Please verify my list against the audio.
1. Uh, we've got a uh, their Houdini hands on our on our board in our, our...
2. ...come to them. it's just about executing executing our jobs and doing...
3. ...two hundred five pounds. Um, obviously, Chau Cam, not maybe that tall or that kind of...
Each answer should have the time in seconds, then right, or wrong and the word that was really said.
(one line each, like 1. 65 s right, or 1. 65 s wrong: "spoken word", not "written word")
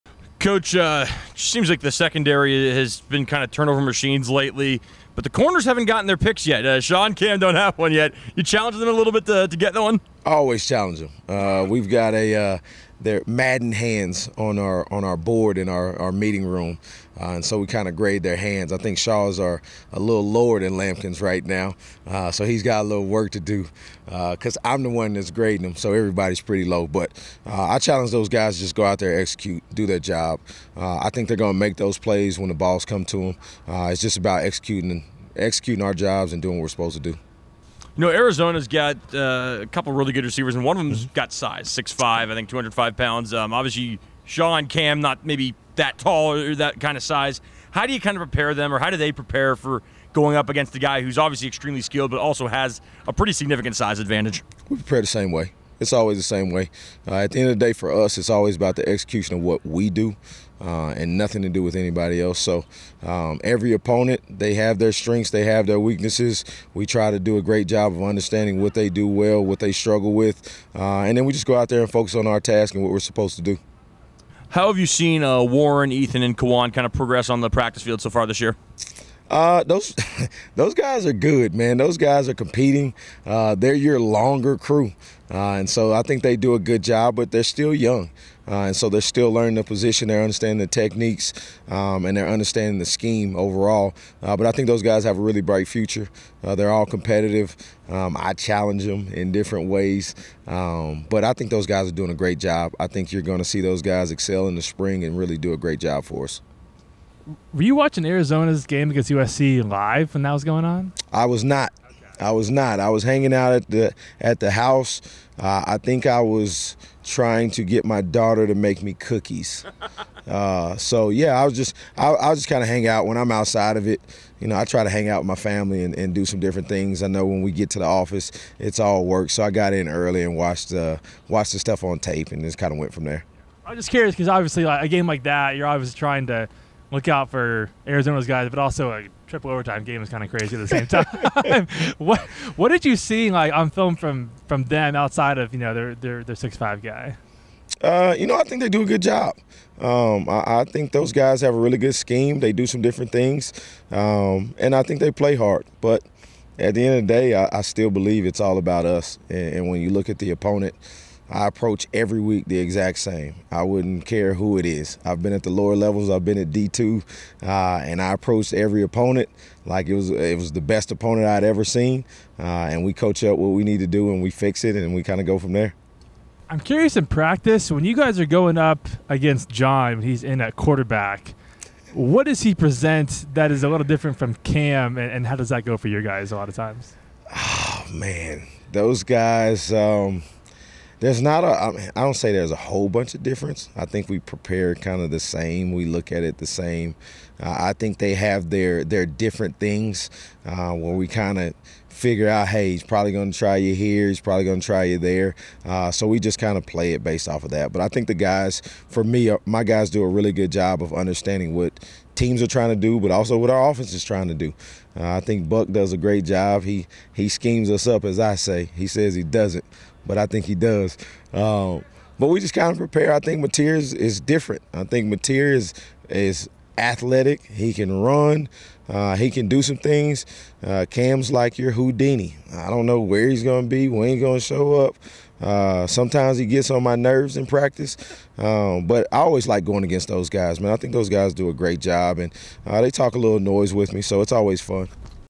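1. 11 s wrong: "Madden", not "Houdini"
2. 32 s right
3. 42 s right.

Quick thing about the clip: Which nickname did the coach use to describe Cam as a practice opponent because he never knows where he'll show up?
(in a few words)
Houdini.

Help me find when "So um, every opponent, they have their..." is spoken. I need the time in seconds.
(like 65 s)
62 s.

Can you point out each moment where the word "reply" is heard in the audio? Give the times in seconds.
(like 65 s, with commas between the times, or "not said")
not said.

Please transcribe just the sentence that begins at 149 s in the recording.
Um, I, I, think those guys have a really good scheme.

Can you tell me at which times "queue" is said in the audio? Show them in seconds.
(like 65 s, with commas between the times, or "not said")
not said.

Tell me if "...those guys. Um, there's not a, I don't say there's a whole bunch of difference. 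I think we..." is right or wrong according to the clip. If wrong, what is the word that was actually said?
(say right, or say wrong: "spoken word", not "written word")
right.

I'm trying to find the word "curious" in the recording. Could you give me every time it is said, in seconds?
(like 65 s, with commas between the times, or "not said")
133 s, 176 s.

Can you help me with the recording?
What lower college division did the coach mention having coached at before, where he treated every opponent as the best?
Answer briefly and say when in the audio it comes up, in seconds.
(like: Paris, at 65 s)
D2, at 166 s.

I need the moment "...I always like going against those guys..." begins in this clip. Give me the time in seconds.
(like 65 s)
239 s.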